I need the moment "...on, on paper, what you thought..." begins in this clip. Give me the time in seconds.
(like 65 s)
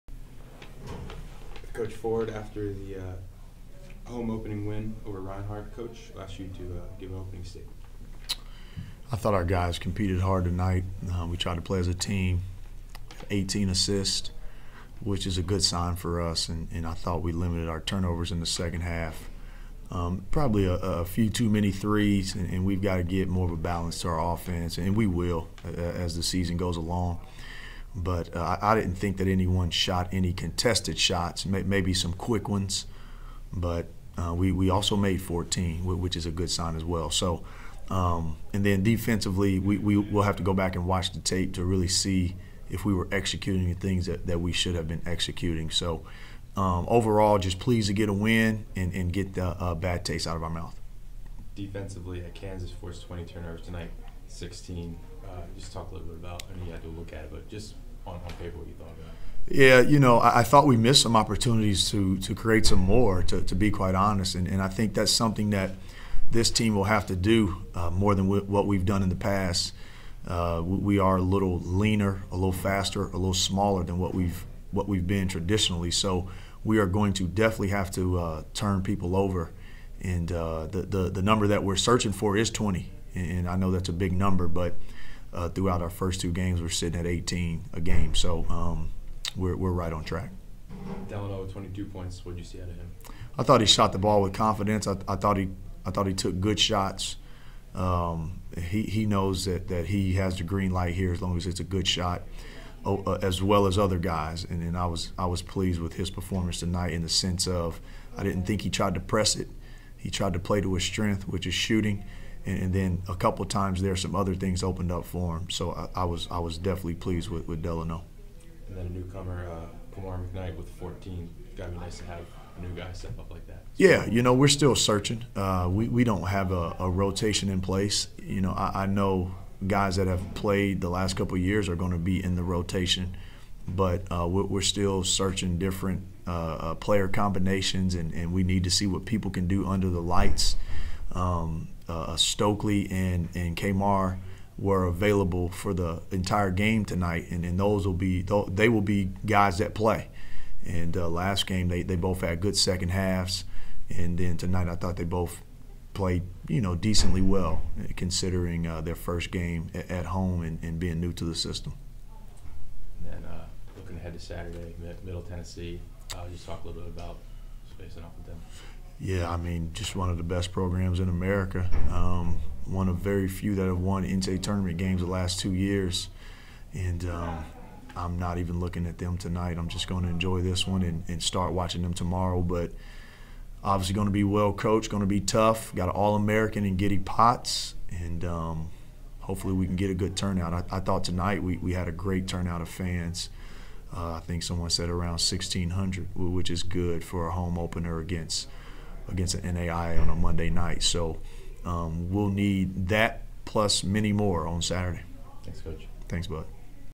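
58 s.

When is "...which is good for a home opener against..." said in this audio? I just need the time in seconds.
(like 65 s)
196 s.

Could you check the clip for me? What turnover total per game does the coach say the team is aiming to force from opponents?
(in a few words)
20.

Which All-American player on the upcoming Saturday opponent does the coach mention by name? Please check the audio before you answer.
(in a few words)
Giddy Potts.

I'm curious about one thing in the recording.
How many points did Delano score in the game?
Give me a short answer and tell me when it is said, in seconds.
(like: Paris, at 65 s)
22, at 91 s.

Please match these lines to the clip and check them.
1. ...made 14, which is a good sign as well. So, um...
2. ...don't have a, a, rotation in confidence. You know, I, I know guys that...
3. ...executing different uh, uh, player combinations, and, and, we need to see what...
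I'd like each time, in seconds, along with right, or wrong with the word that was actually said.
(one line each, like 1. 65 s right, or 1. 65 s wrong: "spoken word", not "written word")
1. 34 s right
2. 126 s wrong: "place", not "confidence"
3. 135 s wrong: "searching", not "executing".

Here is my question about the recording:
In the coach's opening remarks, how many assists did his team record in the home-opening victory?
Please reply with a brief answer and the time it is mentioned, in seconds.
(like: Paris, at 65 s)
18, at 13 s.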